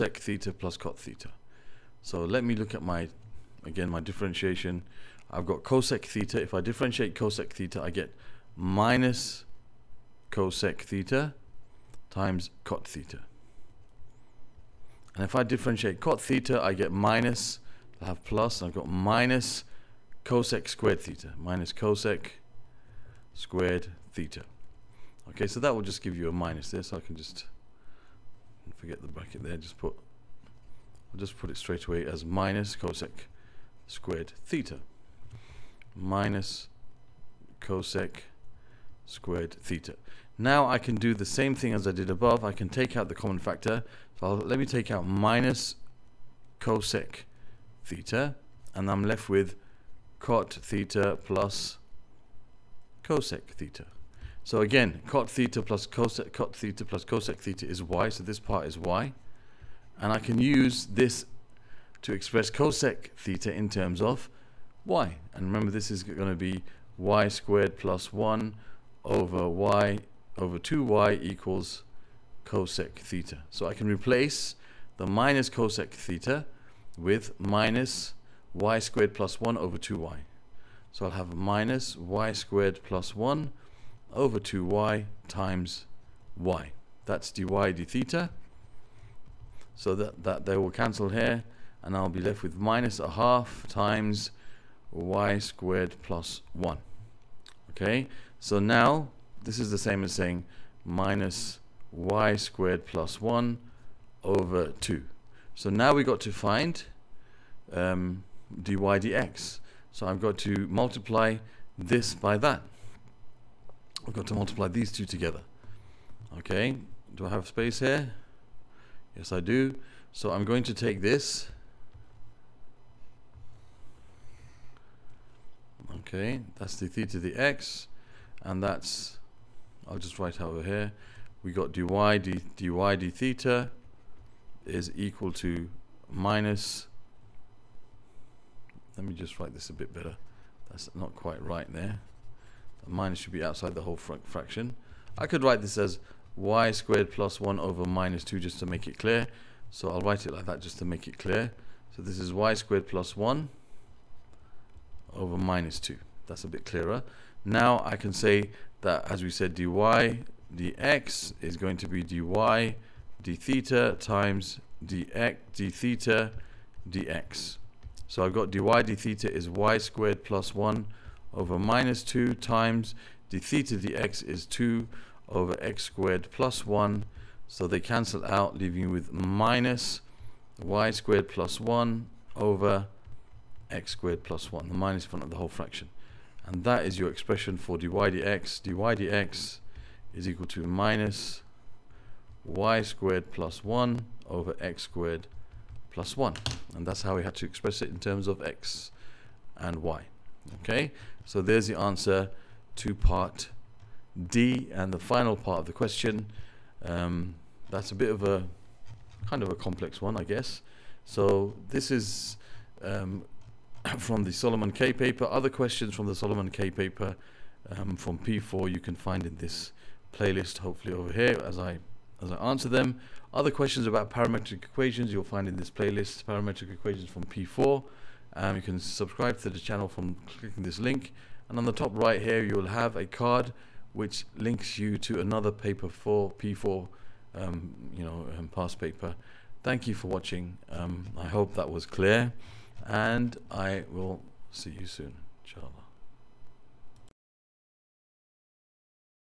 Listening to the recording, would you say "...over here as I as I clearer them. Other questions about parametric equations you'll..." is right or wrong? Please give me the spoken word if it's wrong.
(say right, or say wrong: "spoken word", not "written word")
wrong: "answer", not "clearer".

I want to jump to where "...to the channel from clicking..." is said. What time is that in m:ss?
3:49.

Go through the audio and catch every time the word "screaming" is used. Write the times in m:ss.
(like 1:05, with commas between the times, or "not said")
not said.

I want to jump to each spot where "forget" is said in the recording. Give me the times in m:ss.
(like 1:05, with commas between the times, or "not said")
0:28.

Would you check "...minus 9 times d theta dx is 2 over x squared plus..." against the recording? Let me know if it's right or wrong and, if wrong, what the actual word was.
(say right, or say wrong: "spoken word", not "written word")
wrong: "2", not "9".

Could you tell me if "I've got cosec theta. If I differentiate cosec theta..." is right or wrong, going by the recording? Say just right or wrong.
right.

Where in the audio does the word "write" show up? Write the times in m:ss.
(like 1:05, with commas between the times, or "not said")
2:10, 2:19, 2:25, 2:30.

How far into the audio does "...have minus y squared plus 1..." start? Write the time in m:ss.
1:21.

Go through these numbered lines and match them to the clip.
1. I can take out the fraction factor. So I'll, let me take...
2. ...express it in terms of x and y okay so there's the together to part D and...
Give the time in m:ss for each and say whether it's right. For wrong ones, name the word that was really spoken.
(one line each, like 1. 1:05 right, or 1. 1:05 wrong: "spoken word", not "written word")
1. 0:42 wrong: "common", not "fraction"
2. 3:17 wrong: "answer", not "together".